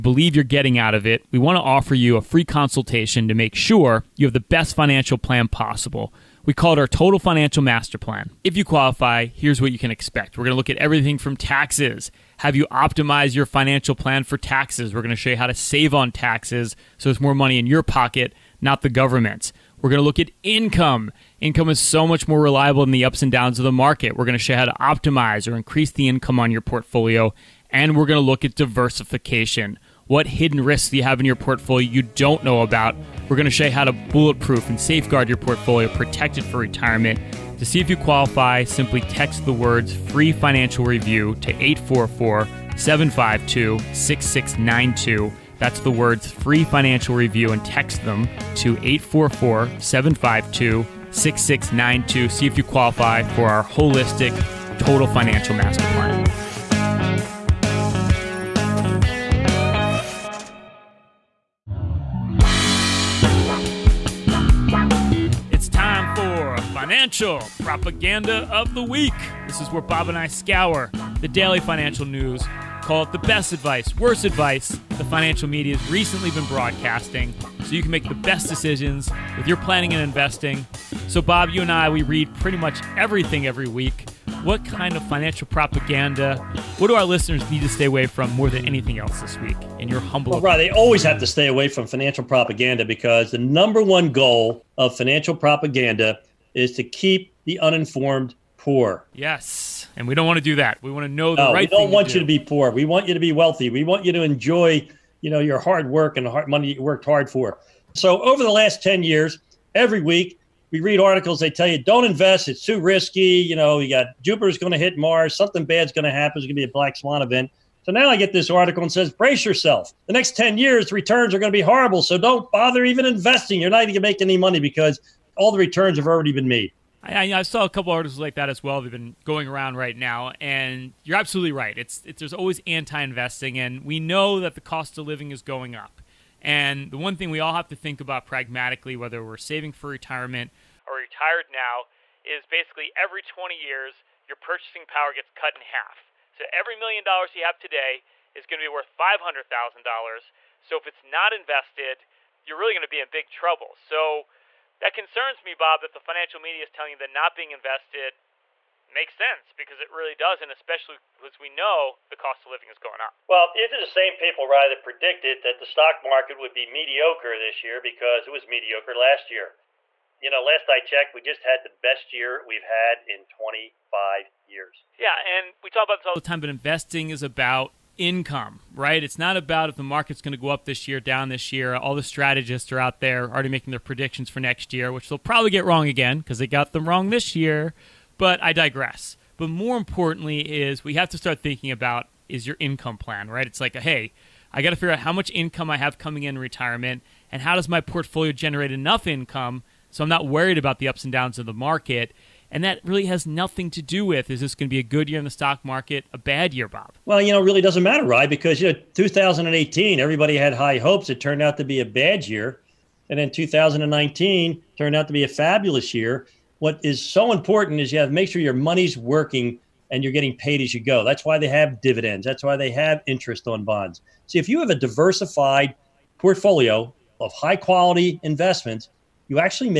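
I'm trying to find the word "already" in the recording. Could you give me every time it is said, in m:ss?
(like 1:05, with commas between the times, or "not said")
2:06, 3:03.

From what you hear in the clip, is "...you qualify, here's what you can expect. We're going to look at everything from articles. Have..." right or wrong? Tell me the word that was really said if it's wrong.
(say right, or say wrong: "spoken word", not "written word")
wrong: "taxes", not "articles".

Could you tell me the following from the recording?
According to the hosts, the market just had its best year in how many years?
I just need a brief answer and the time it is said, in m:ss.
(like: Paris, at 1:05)
25, at 2:53.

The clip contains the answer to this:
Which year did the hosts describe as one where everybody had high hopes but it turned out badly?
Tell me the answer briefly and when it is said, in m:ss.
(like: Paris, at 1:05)
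2018, at 3:28.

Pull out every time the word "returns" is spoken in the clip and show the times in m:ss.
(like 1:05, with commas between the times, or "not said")
2:00, 2:05.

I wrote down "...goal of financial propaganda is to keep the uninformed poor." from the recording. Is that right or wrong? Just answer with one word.
right.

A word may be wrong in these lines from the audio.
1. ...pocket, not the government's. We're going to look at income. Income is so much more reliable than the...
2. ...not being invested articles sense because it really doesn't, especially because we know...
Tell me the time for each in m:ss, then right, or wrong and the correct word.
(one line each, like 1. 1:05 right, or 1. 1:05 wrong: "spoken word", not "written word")
1. 0:17 right
2. 2:37 wrong: "makes", not "articles".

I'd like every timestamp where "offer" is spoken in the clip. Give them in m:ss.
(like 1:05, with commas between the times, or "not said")
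0:01.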